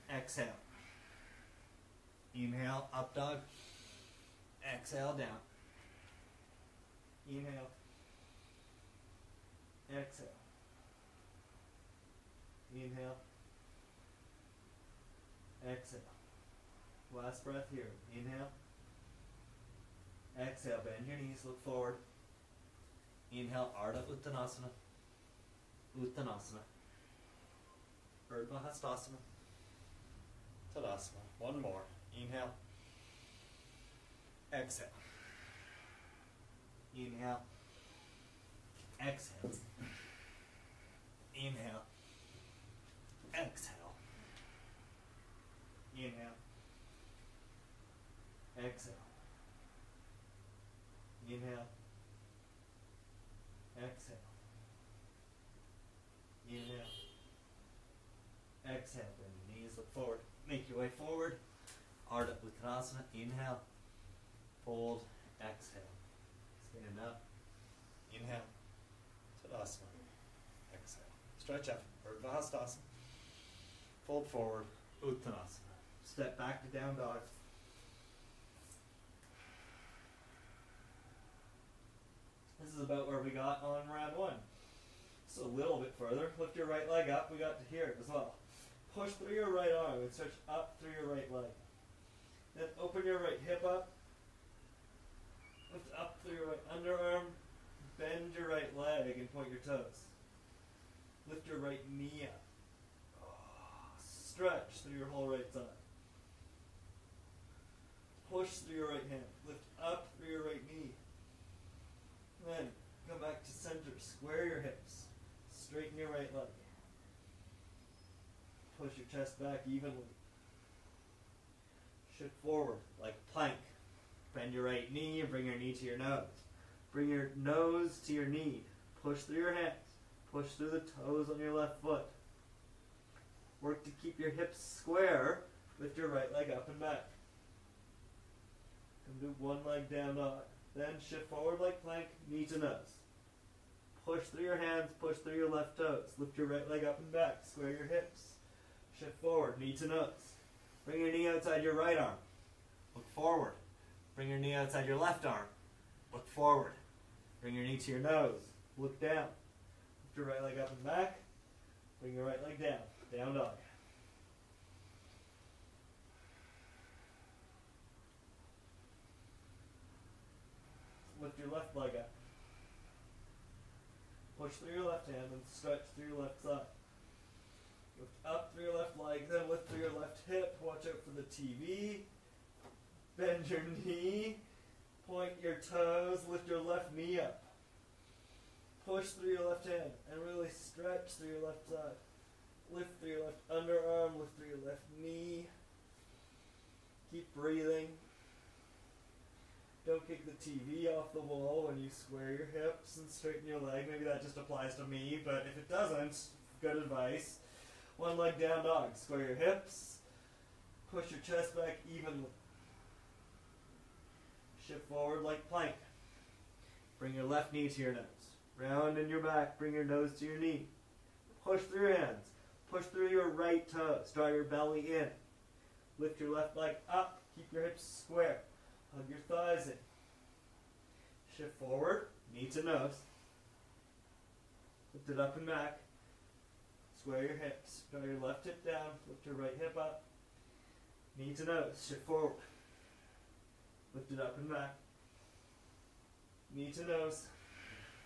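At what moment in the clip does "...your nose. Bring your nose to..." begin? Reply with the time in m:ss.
2:05.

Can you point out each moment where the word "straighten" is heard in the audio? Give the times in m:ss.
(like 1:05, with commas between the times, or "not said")
1:55, 3:23.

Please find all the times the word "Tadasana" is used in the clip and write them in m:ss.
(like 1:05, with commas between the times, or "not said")
0:30, 1:09.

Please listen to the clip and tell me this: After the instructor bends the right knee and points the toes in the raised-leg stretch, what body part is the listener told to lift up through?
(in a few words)
Right underarm.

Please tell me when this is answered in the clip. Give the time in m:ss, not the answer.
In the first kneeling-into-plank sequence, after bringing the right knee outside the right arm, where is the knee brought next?
2:34.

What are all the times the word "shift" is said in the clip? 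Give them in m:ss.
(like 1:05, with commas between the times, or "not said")
2:02, 2:21, 2:28, 3:34, 3:51, 4:01.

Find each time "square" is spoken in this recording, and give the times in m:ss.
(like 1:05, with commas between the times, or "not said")
1:53, 2:14, 2:27, 3:21, 3:28, 3:47, 3:57.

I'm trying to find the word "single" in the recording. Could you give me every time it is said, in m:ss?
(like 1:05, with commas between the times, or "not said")
not said.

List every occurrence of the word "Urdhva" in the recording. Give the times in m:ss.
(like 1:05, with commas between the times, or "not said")
0:28, 1:12.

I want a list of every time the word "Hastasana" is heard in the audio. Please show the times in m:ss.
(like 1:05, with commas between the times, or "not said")
0:28, 1:12.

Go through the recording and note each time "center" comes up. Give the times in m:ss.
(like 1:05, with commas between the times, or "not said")
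1:53.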